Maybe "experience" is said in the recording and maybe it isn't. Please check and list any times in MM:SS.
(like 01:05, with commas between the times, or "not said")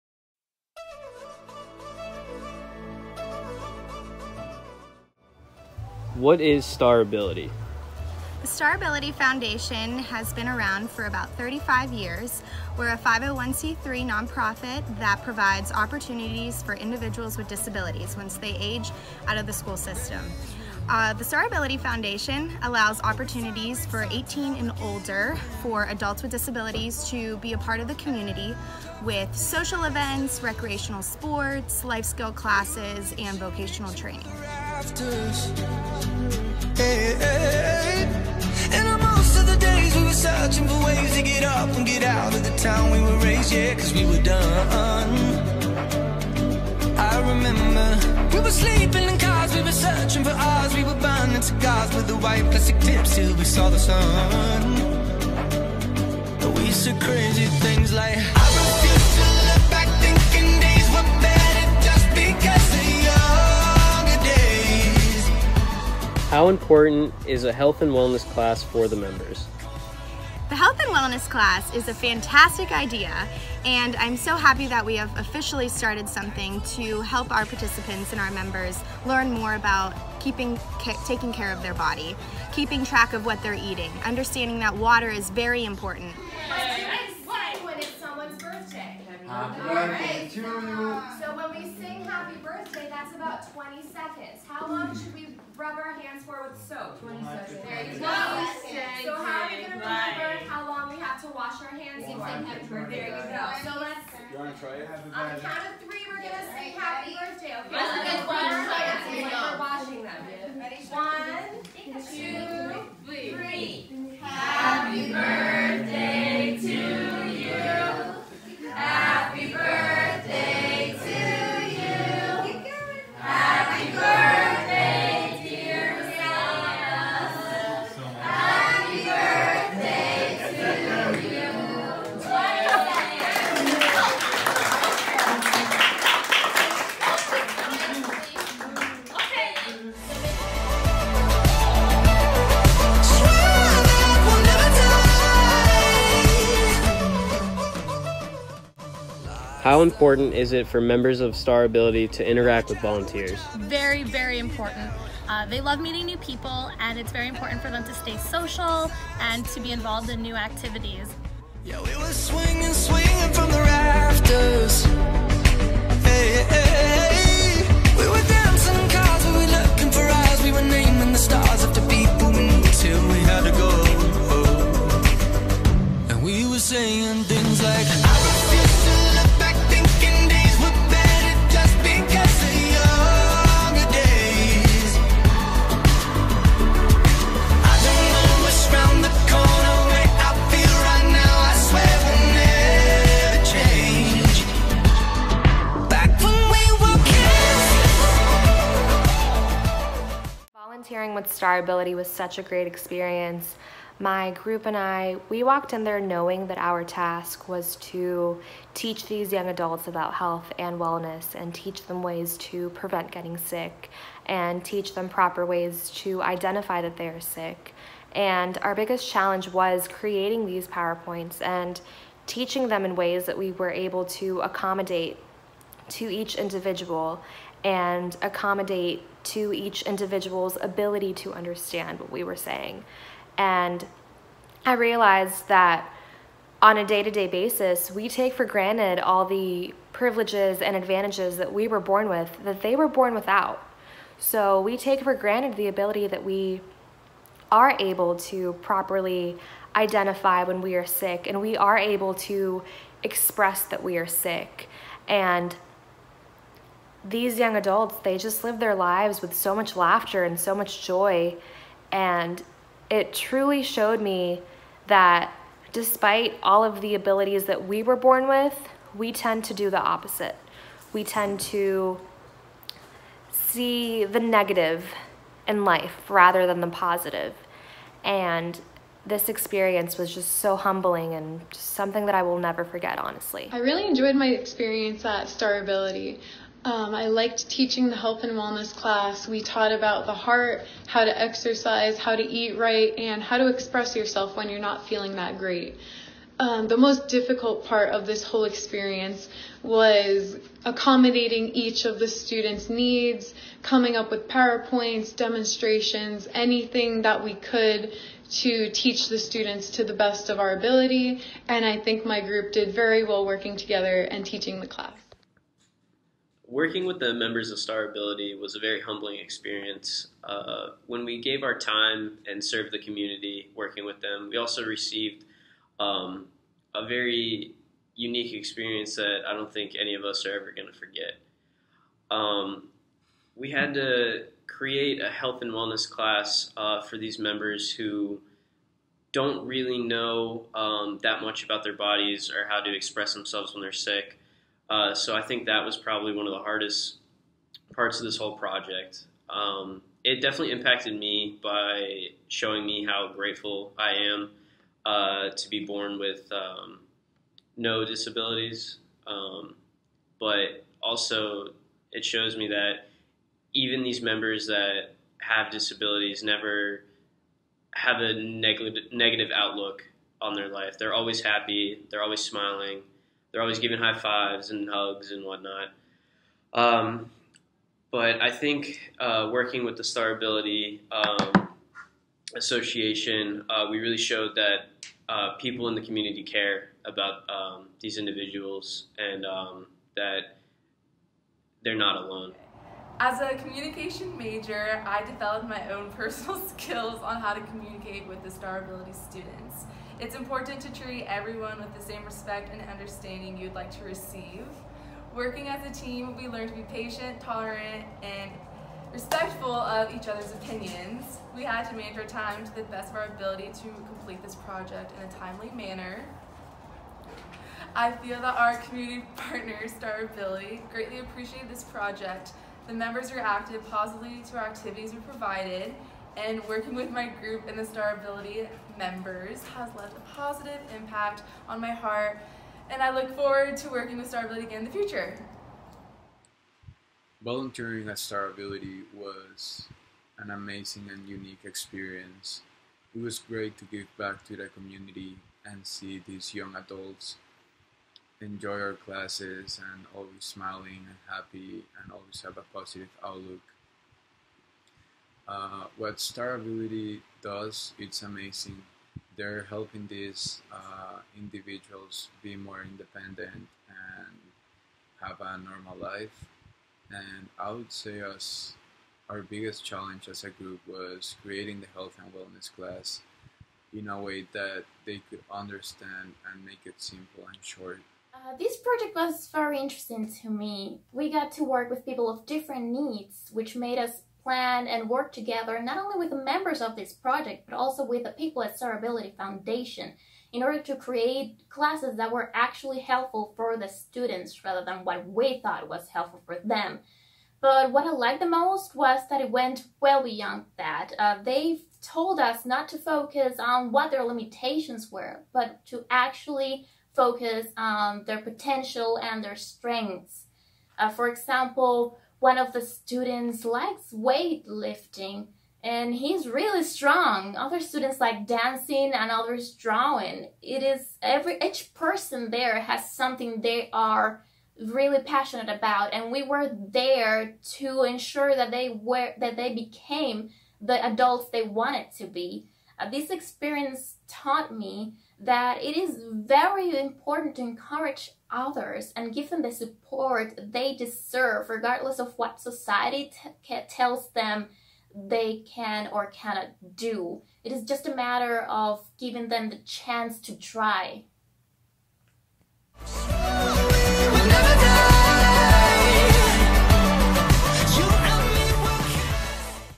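03:22, 04:39, 04:44, 04:58, 05:19, 05:28, 07:21, 08:53.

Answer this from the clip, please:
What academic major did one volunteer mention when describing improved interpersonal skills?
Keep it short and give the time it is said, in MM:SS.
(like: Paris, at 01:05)
Communication, at 06:33.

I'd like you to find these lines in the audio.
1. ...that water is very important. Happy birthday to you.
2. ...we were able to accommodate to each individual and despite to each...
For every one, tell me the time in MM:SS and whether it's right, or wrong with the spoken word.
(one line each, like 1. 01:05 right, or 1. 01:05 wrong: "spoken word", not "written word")
1. 01:24 right
2. 03:43 wrong: "accommodate", not "despite".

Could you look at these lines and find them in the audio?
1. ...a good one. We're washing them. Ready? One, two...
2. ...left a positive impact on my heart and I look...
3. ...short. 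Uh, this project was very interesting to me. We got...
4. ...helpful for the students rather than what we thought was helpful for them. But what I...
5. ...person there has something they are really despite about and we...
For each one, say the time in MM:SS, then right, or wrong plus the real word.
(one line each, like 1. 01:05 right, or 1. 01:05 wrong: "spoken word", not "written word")
1. 01:47 right
2. 07:09 right
3. 07:57 right
4. 08:12 right
5. 08:41 wrong: "passionate", not "despite".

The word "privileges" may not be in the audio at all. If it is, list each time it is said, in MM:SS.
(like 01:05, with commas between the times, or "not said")
03:59.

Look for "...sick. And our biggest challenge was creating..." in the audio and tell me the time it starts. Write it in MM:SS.
03:37.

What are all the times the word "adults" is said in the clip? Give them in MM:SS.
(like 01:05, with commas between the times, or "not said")
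00:25, 03:29, 04:17, 07:26, 08:50.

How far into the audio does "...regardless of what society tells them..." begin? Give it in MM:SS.
09:01.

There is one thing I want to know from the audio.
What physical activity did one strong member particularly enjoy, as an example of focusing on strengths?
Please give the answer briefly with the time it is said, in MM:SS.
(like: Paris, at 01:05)
Weightlifting, at 08:33.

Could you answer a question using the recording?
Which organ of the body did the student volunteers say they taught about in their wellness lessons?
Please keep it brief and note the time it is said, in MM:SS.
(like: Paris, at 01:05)
The heart, at 04:50.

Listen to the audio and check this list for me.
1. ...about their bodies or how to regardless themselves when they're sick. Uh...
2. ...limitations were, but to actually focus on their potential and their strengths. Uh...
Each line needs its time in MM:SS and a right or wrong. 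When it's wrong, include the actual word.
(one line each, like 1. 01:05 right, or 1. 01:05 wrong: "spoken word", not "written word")
1. 05:41 wrong: "express", not "regardless"
2. 08:24 right.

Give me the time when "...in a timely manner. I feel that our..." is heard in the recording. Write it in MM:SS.
06:54.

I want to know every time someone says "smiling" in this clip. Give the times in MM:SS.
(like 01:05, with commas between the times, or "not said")
06:12, 07:30.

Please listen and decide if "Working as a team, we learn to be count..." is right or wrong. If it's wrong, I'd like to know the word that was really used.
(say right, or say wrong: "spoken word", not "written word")
wrong: "patient", not "count".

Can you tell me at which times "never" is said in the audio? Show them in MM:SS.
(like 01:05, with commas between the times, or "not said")
04:42, 06:06.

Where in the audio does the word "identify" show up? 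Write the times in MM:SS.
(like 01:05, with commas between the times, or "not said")
03:36, 04:09.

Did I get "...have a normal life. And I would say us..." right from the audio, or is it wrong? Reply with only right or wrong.
right.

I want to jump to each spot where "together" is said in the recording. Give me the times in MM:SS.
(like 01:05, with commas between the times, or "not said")
05:13, 08:05.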